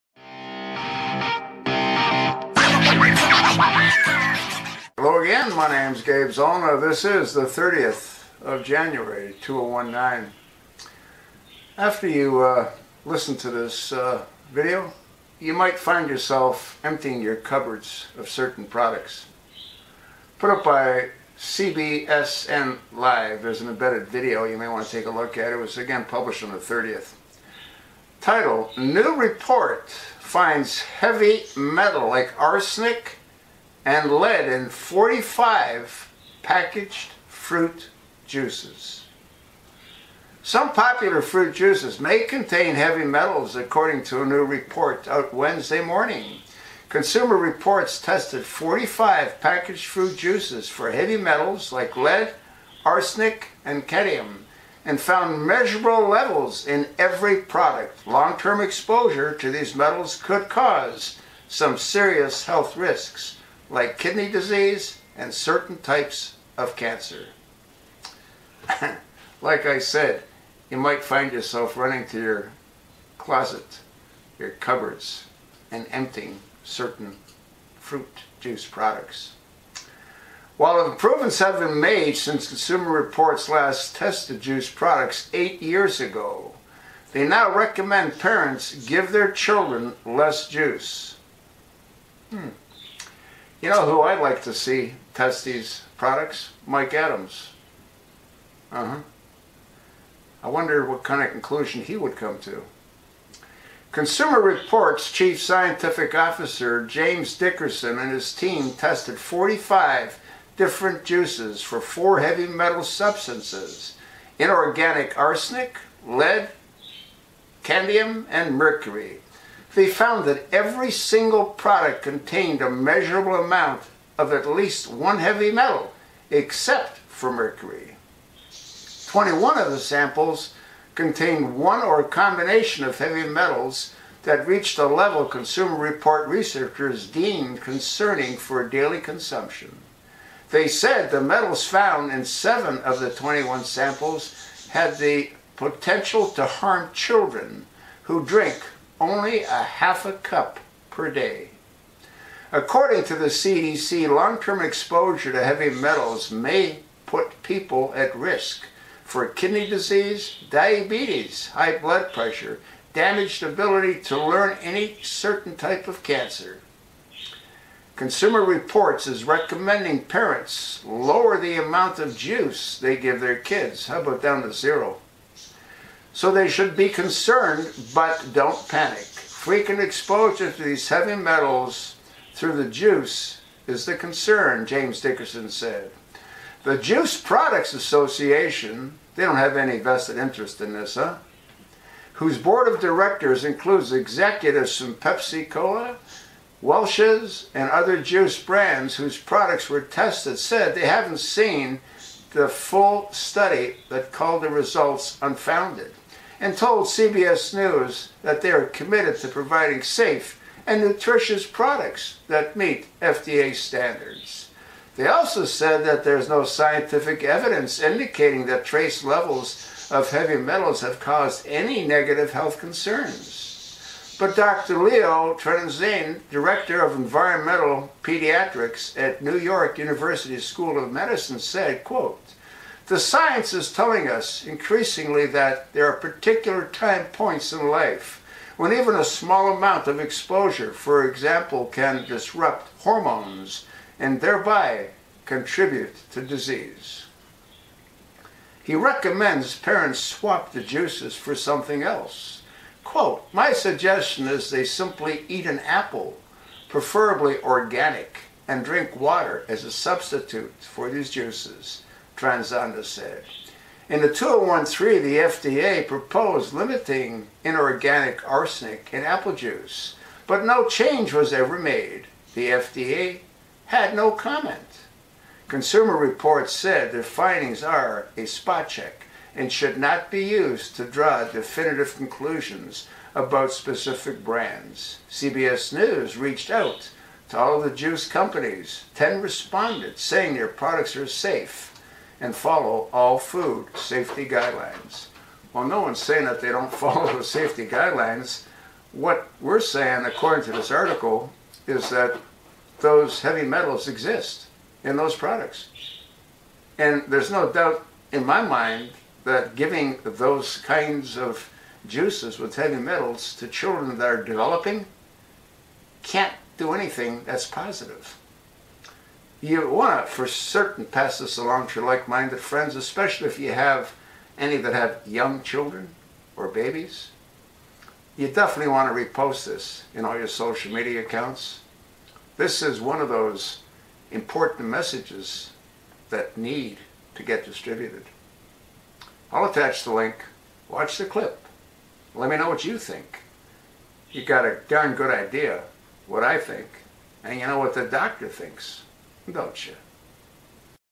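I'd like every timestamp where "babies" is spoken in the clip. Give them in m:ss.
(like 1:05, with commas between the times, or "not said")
5:26.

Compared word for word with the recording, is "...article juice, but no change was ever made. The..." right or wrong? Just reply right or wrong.
wrong.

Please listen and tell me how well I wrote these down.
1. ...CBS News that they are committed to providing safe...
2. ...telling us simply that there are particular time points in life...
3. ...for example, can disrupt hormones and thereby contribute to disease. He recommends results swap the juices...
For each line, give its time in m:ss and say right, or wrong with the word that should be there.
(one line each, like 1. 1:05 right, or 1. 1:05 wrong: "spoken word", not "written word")
1. 3:26 right
2. 3:53 wrong: "increasingly", not "simply"
3. 4:00 wrong: "parents", not "results".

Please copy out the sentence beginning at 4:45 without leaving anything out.
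CBS News reached out to all the juice companies.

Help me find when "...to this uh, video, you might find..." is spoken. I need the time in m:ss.
0:13.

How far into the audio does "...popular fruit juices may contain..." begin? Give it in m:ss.
0:40.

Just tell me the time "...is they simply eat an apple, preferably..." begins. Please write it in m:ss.
4:14.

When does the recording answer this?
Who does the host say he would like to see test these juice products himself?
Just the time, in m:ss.
1:36.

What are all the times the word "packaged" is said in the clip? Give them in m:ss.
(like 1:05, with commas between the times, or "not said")
0:36, 0:49.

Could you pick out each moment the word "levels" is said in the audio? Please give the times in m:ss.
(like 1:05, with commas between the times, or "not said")
0:56, 2:14, 3:39.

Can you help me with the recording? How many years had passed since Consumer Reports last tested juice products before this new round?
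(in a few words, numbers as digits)
8.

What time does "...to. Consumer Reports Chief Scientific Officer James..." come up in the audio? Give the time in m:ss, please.
1:42.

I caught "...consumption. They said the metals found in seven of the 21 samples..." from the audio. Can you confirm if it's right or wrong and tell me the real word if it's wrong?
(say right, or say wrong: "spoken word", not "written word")
right.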